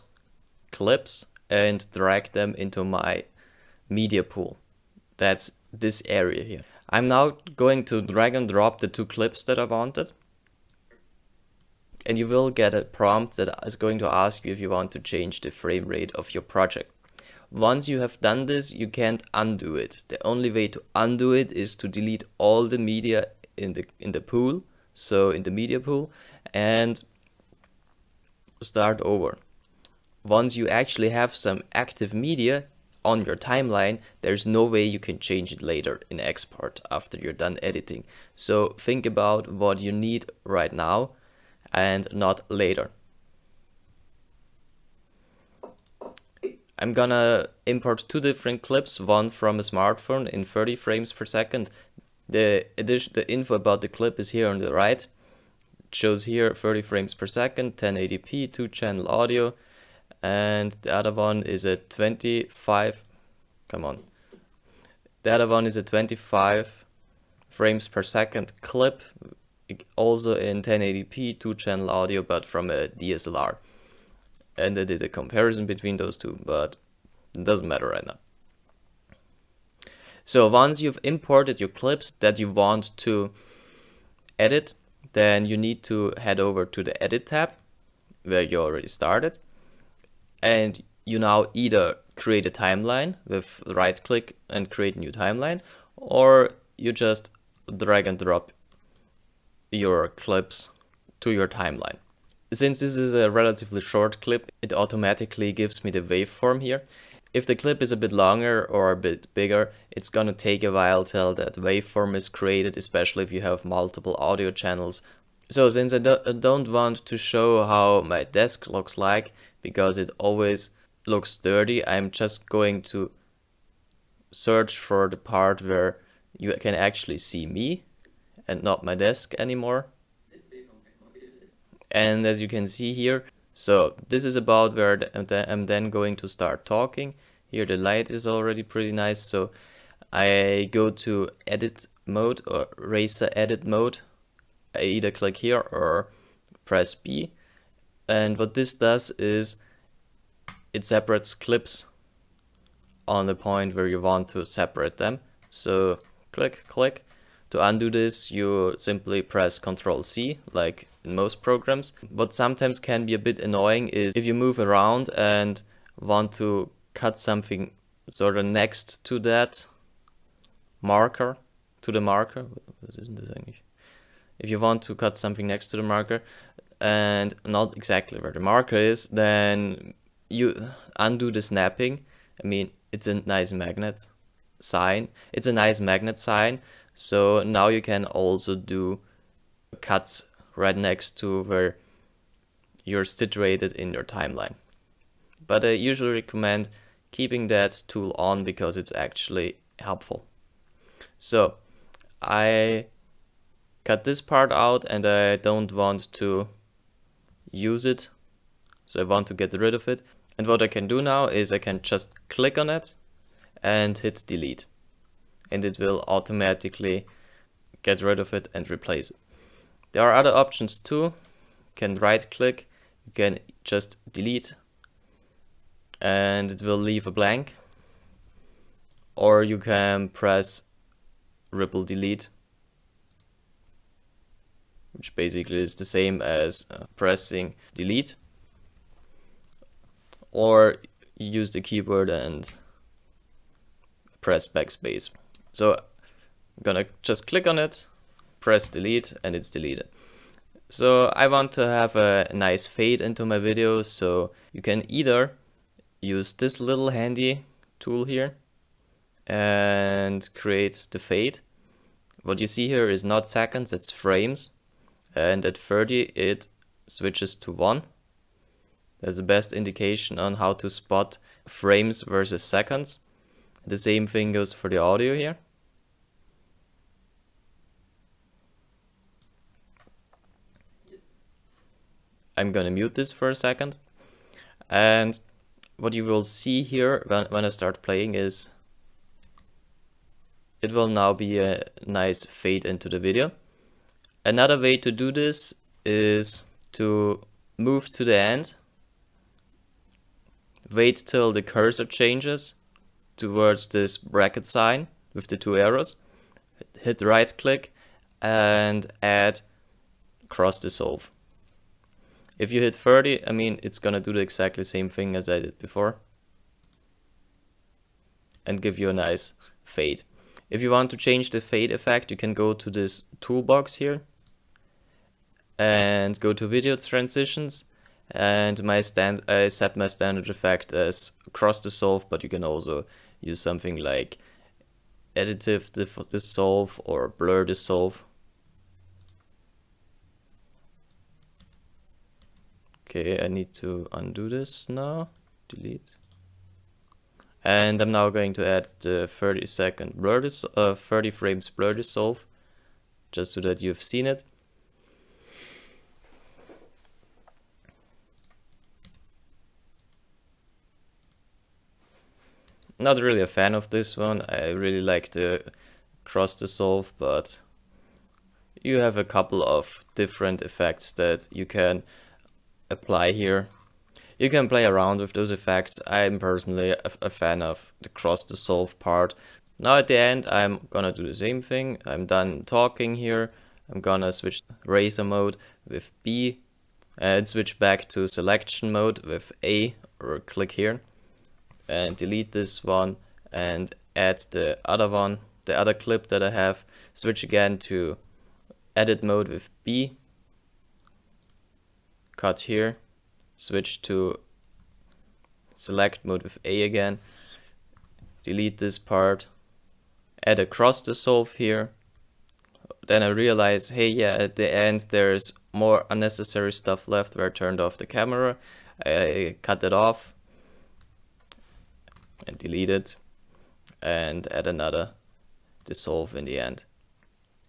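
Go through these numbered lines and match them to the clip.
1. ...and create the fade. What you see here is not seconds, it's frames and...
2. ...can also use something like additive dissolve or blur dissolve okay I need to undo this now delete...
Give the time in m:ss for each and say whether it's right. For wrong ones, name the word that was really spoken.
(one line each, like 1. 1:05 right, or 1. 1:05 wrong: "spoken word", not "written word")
1. 4:19 right
2. 5:32 right.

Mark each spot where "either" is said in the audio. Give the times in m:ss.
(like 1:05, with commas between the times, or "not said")
1:31, 2:24, 4:14.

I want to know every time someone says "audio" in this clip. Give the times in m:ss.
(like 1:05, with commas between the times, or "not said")
0:59, 1:11, 1:54, 4:34.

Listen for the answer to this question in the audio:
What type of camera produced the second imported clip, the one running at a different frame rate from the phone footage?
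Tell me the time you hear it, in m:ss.
1:12.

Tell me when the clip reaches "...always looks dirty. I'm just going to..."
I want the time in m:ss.
2:00.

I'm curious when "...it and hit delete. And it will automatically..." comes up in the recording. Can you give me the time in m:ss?
3:32.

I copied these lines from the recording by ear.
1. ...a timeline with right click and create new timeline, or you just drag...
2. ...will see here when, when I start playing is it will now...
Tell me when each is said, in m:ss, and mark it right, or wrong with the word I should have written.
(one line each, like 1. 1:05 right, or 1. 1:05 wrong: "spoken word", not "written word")
1. 1:32 right
2. 4:46 right.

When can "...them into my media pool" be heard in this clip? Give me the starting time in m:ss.
0:02.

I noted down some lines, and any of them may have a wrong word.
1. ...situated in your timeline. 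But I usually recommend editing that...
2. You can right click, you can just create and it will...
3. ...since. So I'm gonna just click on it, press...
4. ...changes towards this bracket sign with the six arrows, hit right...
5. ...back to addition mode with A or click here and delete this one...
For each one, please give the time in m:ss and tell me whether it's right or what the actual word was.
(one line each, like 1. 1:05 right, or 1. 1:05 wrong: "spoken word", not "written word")
1. 3:13 wrong: "keeping", not "editing"
2. 3:41 wrong: "delete", not "create"
3. 4:04 wrong: "backspace", not "since"
4. 5:01 wrong: "two", not "six"
5. 6:27 wrong: "selection", not "addition".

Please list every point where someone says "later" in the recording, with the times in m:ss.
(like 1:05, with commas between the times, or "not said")
0:35, 0:42.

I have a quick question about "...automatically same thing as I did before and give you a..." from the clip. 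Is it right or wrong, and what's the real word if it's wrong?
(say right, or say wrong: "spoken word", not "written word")
wrong: "exactly", not "automatically".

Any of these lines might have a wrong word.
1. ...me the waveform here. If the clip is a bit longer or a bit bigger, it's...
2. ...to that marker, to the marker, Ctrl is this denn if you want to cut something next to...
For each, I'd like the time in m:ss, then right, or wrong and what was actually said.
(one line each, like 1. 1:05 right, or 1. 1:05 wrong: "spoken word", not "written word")
1. 1:45 right
2. 2:49 wrong: "What", not "Ctrl".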